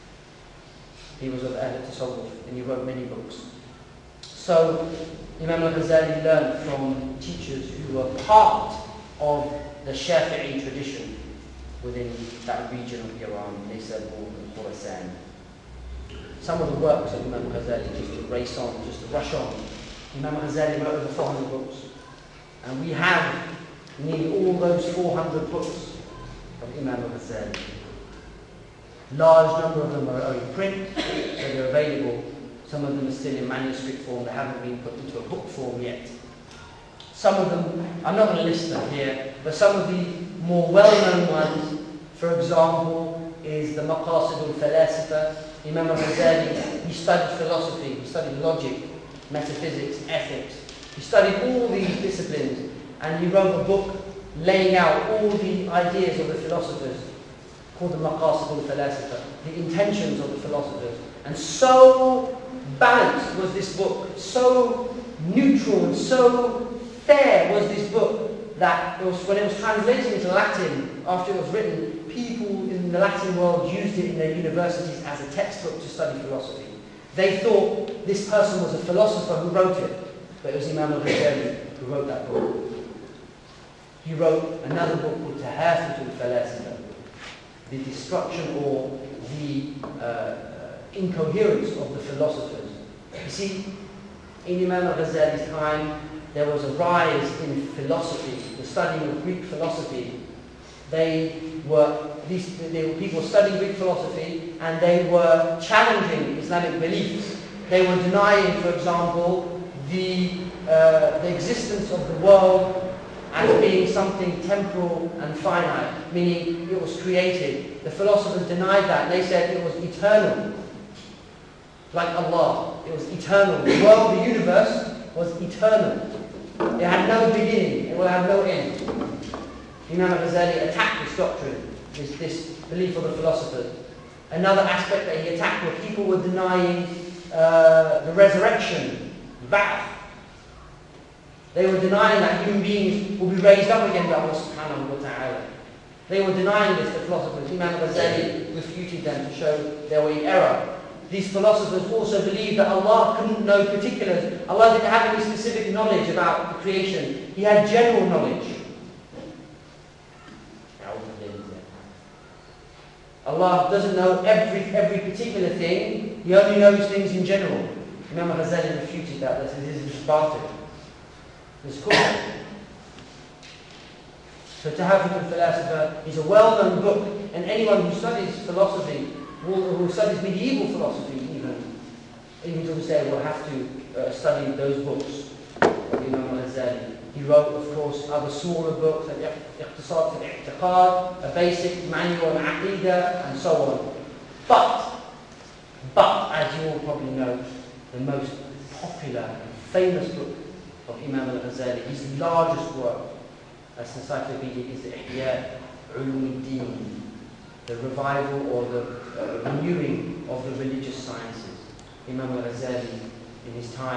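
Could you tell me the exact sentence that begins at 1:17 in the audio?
They thought this person was a philosopher who wrote it, but it was Imam al-Ghazali who wrote that book.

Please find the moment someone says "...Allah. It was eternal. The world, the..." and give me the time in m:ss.
2:02.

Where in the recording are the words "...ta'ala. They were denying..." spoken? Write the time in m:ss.
2:24.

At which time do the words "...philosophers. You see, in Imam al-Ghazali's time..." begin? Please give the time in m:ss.
1:31.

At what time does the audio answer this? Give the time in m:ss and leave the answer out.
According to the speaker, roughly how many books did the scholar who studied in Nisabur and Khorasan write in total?
0:20.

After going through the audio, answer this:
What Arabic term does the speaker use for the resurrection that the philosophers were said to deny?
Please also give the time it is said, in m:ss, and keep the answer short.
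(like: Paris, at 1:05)
Ba'ath, at 2:19.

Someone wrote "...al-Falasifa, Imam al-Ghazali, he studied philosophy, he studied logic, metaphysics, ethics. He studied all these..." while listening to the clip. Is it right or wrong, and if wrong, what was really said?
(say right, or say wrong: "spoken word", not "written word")
right.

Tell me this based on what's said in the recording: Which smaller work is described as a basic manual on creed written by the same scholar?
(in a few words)
Iqtisad al-I'tiqad.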